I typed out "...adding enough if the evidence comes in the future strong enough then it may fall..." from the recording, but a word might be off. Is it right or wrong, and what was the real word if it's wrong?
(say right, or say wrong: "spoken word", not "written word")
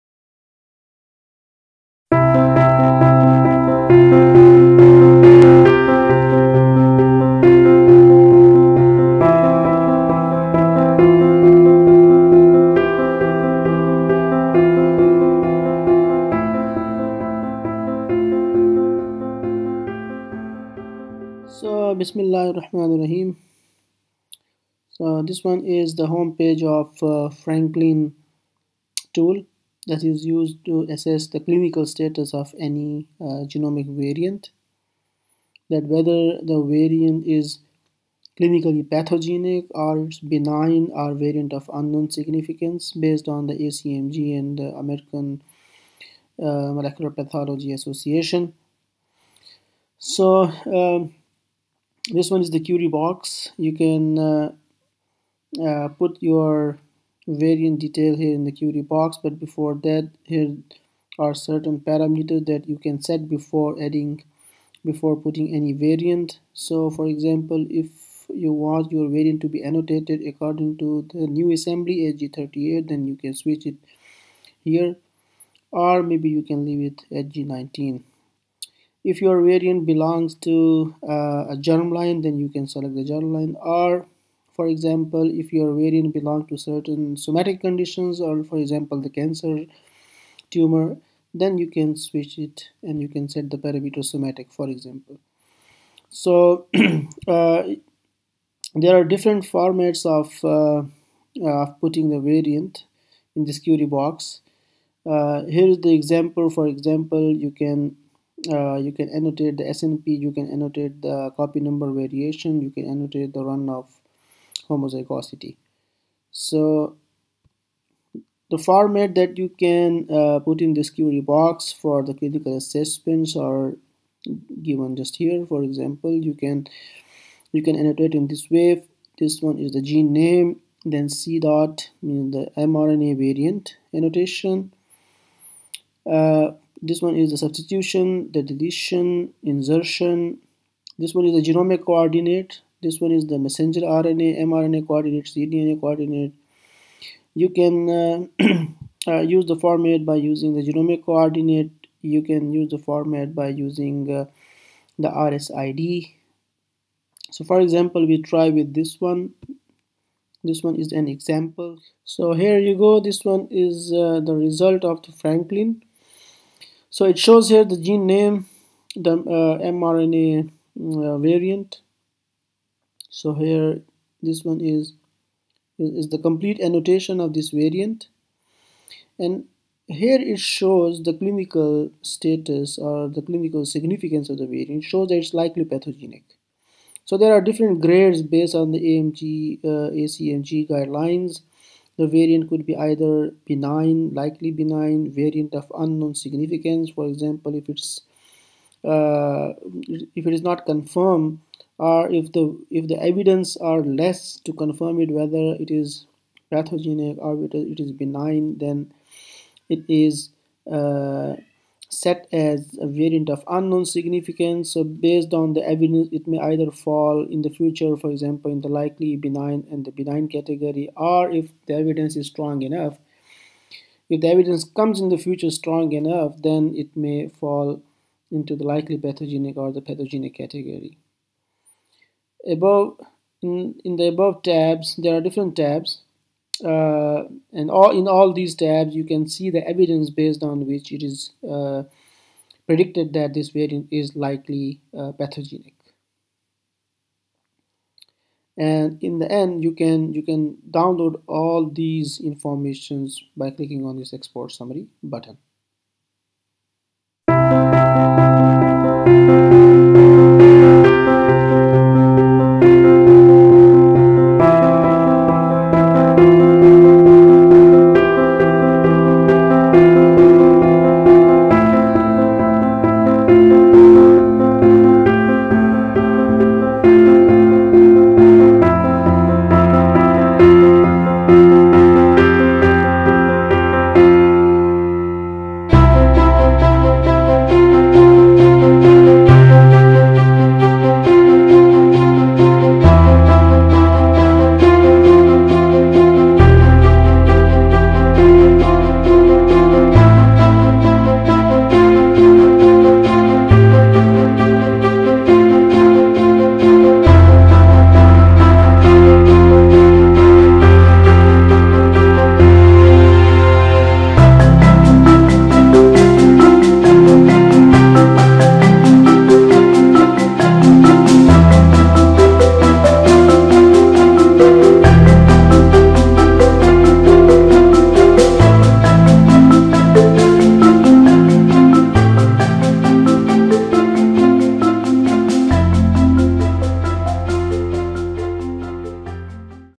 wrong: "strong", not "adding".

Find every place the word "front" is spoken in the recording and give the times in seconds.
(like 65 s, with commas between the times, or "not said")
not said.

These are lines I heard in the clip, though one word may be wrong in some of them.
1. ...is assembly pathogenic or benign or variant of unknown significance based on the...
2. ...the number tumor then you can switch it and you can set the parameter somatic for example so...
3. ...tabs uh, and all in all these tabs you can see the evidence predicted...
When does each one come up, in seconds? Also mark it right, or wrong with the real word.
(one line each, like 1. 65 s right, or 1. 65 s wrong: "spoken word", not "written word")
1. 37 s wrong: "clinically", not "assembly"
2. 89 s wrong: "cancer", not "number"
3. 235 s wrong: "based", not "predicted".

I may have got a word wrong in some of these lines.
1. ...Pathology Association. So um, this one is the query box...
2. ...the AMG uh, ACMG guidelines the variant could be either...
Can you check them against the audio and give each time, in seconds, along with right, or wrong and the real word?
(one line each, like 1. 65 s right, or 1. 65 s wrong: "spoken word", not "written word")
1. 47 s right
2. 188 s right.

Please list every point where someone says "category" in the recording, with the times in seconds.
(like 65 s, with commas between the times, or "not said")
220 s, 230 s.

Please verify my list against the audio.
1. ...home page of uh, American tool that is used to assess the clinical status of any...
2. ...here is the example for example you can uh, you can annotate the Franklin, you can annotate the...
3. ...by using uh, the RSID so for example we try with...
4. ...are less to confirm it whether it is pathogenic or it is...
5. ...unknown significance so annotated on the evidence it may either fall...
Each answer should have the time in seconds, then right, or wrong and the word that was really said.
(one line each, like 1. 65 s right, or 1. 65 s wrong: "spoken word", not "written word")
1. 26 s wrong: "Franklin", not "American"
2. 105 s wrong: "SNP", not "Franklin"
3. 153 s right
4. 203 s right
5. 213 s wrong: "based", not "annotated".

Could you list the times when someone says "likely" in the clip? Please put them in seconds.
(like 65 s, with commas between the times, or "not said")
185 s, 194 s, 218 s, 228 s, 244 s.